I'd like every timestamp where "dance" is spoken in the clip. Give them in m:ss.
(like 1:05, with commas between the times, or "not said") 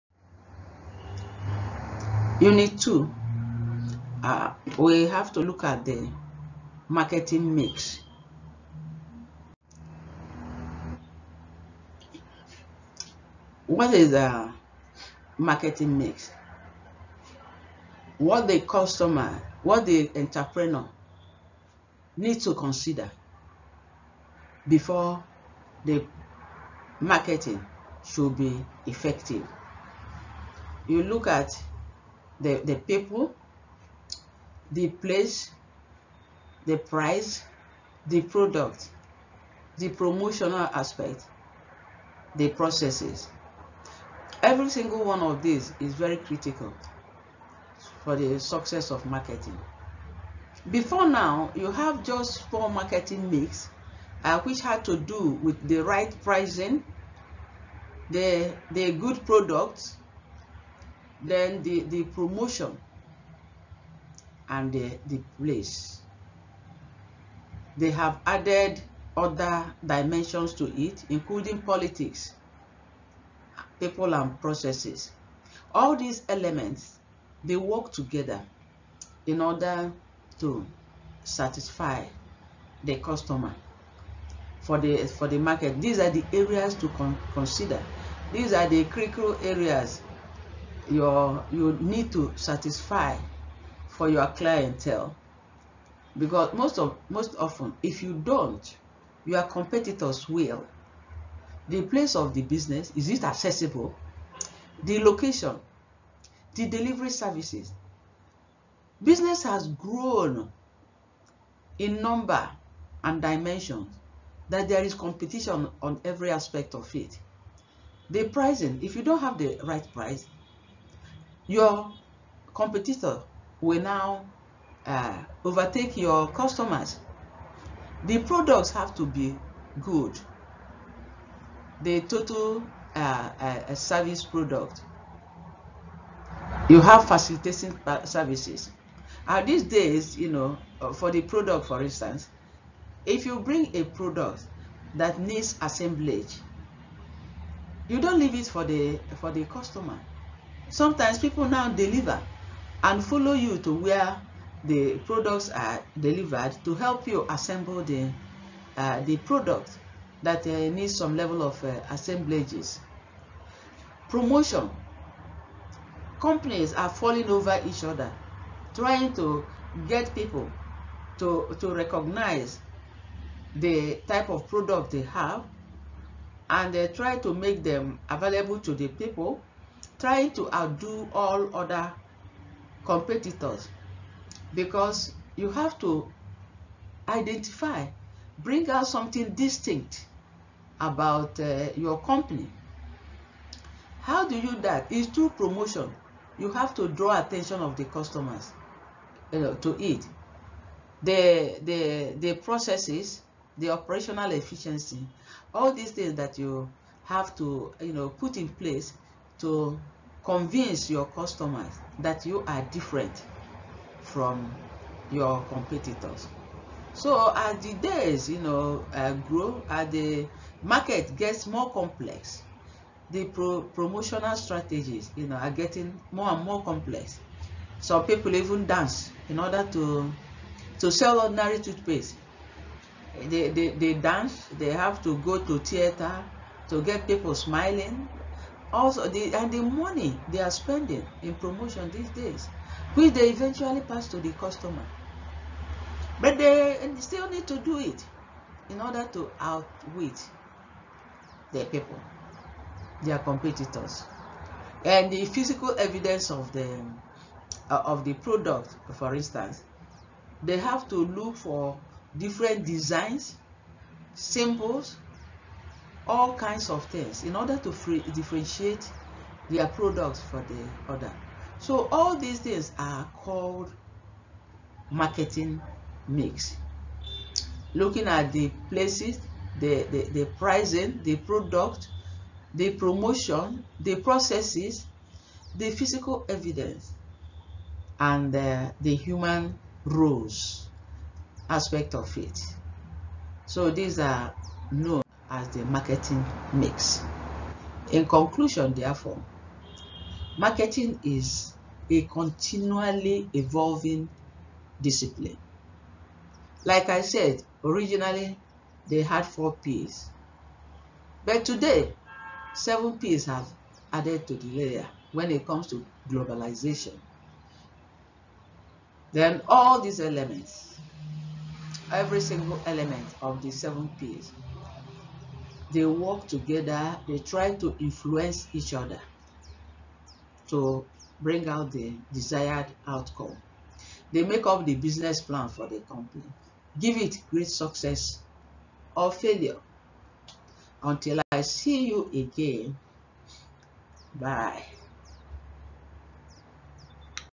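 3:48, 3:53.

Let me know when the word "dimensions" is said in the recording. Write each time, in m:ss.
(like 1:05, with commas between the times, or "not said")
1:09, 1:53.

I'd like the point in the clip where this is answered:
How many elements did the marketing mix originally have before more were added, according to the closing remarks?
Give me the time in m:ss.
5:09.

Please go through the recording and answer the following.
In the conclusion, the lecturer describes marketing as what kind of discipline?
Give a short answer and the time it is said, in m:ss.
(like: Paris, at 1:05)
continually evolving, at 5:02.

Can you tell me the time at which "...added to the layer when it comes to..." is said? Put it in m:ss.
5:13.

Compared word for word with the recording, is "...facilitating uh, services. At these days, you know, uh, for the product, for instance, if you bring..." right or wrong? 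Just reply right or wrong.
right.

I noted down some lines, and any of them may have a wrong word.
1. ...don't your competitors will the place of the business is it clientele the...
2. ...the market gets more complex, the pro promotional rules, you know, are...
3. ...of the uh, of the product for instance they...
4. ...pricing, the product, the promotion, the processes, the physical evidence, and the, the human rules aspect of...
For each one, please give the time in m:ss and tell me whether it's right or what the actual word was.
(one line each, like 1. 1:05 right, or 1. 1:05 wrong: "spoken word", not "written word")
1. 1:38 wrong: "accessible", not "clientele"
2. 3:39 wrong: "strategies", not "rules"
3. 4:16 right
4. 4:40 right.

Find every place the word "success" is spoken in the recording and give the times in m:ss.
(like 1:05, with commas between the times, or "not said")
0:48, 5:37.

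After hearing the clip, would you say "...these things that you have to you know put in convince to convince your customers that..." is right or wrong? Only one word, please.
wrong.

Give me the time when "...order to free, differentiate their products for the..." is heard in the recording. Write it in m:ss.
4:27.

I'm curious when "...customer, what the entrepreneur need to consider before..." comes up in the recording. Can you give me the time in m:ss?
0:18.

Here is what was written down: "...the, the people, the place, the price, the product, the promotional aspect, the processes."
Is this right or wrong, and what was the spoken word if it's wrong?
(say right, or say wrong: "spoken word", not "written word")
right.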